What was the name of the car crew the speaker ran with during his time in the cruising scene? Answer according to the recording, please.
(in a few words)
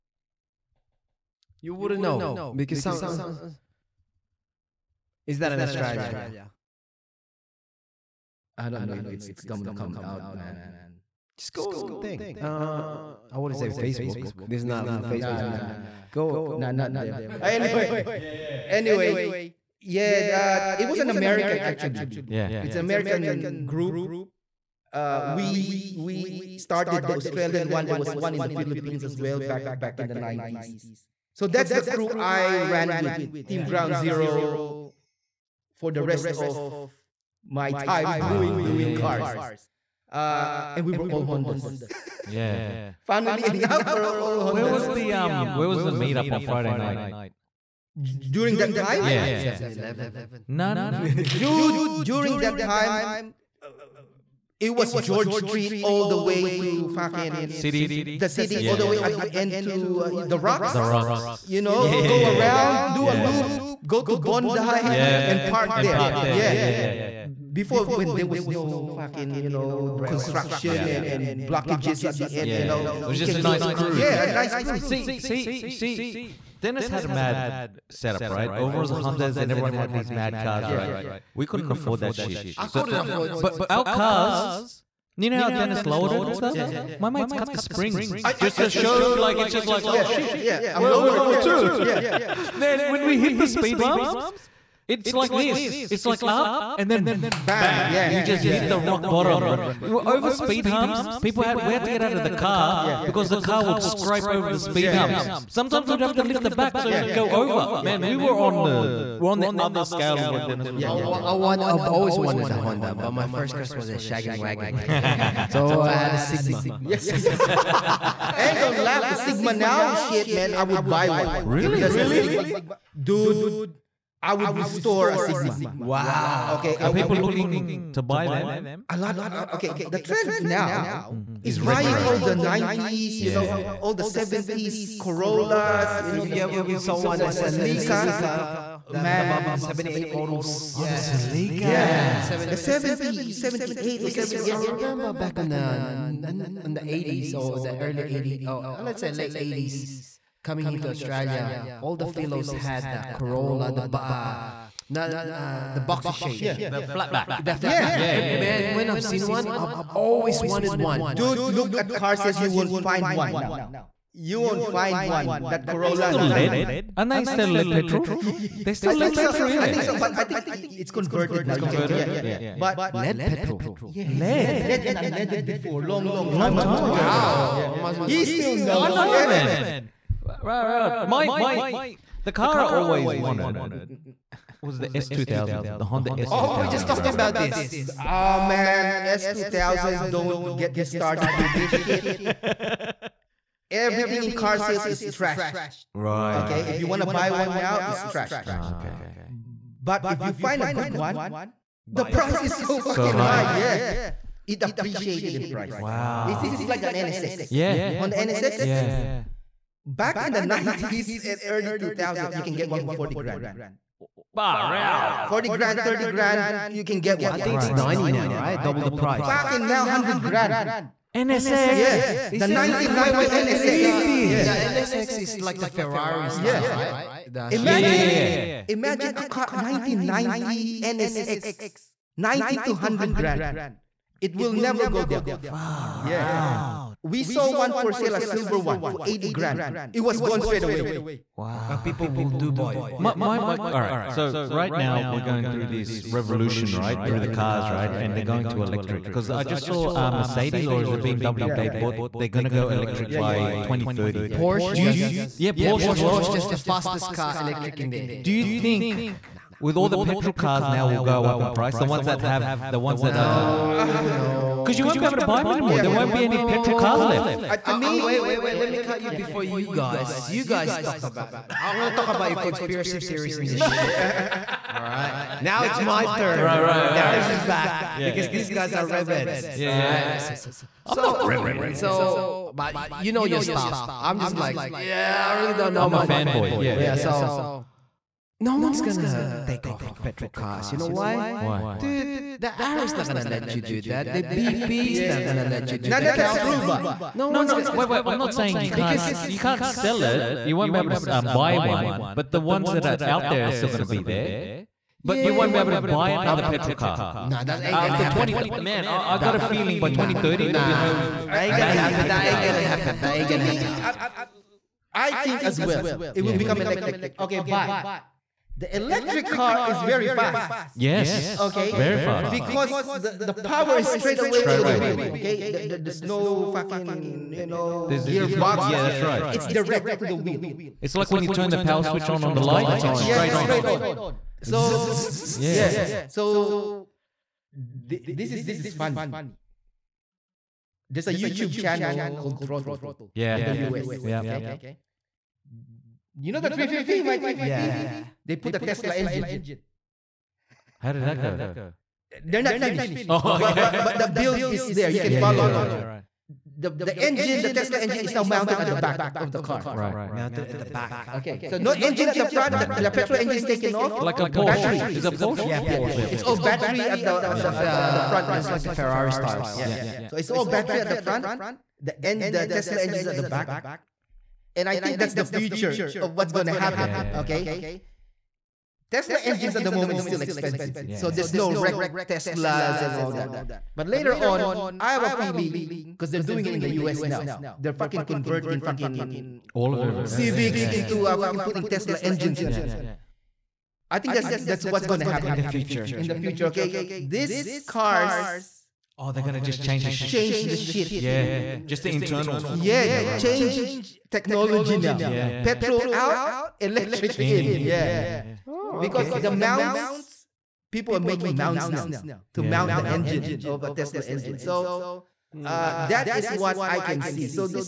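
Ground Zero.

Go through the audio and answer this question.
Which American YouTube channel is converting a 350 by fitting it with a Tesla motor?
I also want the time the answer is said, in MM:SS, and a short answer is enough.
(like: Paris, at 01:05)
Throttle, at 05:42.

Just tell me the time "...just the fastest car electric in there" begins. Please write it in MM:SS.
04:16.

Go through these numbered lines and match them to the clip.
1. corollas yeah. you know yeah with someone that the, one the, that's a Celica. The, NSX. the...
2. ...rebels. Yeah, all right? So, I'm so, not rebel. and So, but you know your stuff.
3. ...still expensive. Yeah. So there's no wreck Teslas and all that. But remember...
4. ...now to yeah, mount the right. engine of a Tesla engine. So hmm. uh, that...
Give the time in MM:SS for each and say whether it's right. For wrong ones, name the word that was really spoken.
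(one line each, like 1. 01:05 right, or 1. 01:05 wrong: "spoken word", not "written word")
1. 02:14 wrong: "Man", not "NSX"
2. 04:38 right
3. 06:20 wrong: "later", not "remember"
4. 06:51 right.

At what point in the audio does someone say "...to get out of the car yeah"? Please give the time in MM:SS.
01:41.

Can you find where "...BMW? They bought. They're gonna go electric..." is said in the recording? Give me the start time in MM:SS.
04:11.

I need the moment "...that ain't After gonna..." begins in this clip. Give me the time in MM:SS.
05:07.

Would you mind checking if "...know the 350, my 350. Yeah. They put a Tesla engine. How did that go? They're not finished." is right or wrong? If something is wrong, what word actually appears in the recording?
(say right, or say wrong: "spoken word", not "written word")
right.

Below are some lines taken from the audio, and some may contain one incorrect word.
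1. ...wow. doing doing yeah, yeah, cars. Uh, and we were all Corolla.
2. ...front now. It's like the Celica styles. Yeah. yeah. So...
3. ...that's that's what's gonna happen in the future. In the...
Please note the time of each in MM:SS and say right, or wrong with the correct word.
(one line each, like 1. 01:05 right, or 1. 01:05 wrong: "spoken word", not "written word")
1. 00:38 wrong: "Hondas", not "Corolla"
2. 06:08 wrong: "Ferrari", not "Celica"
3. 06:34 right.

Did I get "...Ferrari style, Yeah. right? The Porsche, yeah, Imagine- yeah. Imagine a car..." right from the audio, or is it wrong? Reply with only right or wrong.
wrong.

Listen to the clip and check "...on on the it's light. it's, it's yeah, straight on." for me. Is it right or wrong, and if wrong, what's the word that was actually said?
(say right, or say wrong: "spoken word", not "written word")
right.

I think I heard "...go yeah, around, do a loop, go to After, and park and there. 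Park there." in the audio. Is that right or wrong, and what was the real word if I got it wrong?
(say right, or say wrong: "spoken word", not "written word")
wrong: "Bondi", not "After".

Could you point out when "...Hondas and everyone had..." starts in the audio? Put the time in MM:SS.
01:18.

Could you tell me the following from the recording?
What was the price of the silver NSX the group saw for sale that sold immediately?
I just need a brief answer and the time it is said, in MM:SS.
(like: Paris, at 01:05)
80 grand, at 03:59.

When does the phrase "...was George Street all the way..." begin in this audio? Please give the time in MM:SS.
00:54.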